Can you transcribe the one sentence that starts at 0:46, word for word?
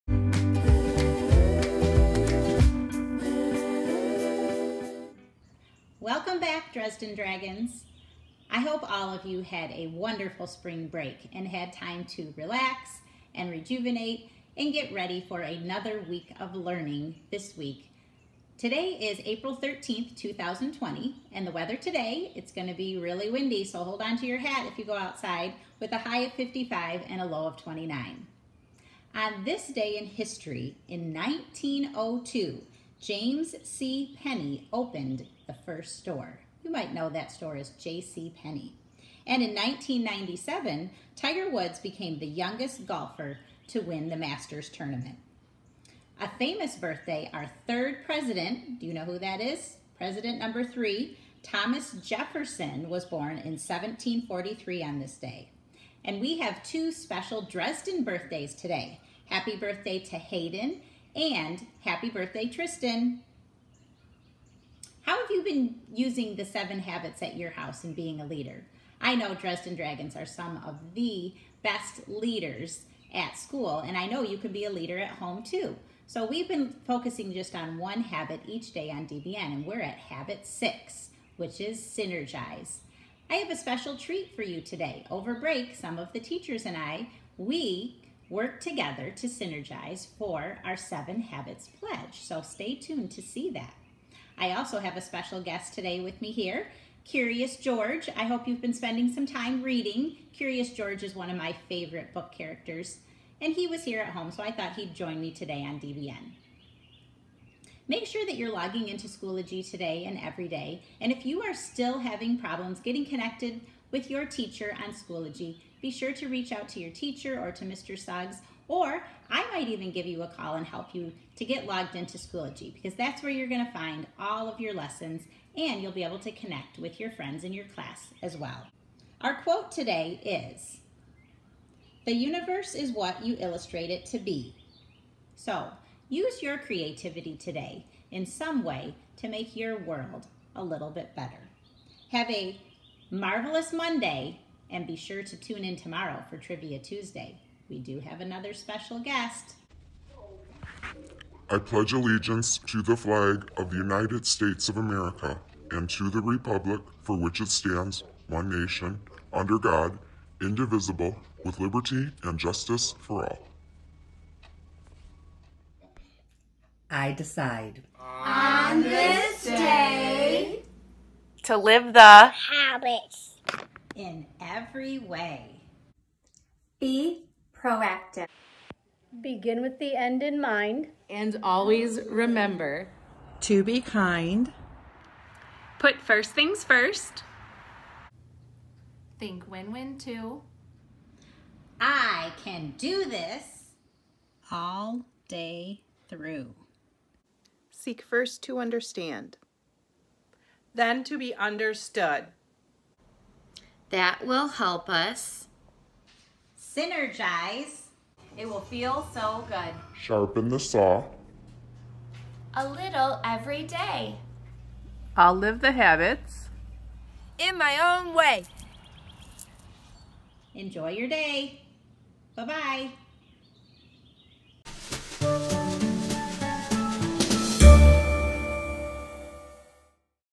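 A famous birthday, our third president, do you know who that is?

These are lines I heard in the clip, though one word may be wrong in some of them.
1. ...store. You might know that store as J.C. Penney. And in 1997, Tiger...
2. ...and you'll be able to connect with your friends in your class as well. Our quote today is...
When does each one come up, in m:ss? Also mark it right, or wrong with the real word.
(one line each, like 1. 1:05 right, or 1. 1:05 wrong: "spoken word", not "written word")
1. 0:35 right
2. 2:05 right.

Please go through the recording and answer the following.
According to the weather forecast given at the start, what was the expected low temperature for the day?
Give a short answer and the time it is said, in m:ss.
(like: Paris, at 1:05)
29, at 0:27.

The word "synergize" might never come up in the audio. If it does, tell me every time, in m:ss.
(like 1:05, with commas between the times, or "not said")
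1:21, 1:29, 3:26.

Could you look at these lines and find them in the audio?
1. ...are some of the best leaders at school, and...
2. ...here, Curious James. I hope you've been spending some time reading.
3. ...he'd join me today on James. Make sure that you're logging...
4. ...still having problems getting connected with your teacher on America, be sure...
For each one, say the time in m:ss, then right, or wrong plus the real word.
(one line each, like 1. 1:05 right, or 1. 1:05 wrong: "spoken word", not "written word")
1. 1:10 right
2. 1:36 wrong: "George", not "James"
3. 1:44 wrong: "DBN", not "James"
4. 1:51 wrong: "Schoology", not "America".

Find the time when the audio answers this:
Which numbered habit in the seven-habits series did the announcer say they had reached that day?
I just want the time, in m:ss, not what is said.
1:20.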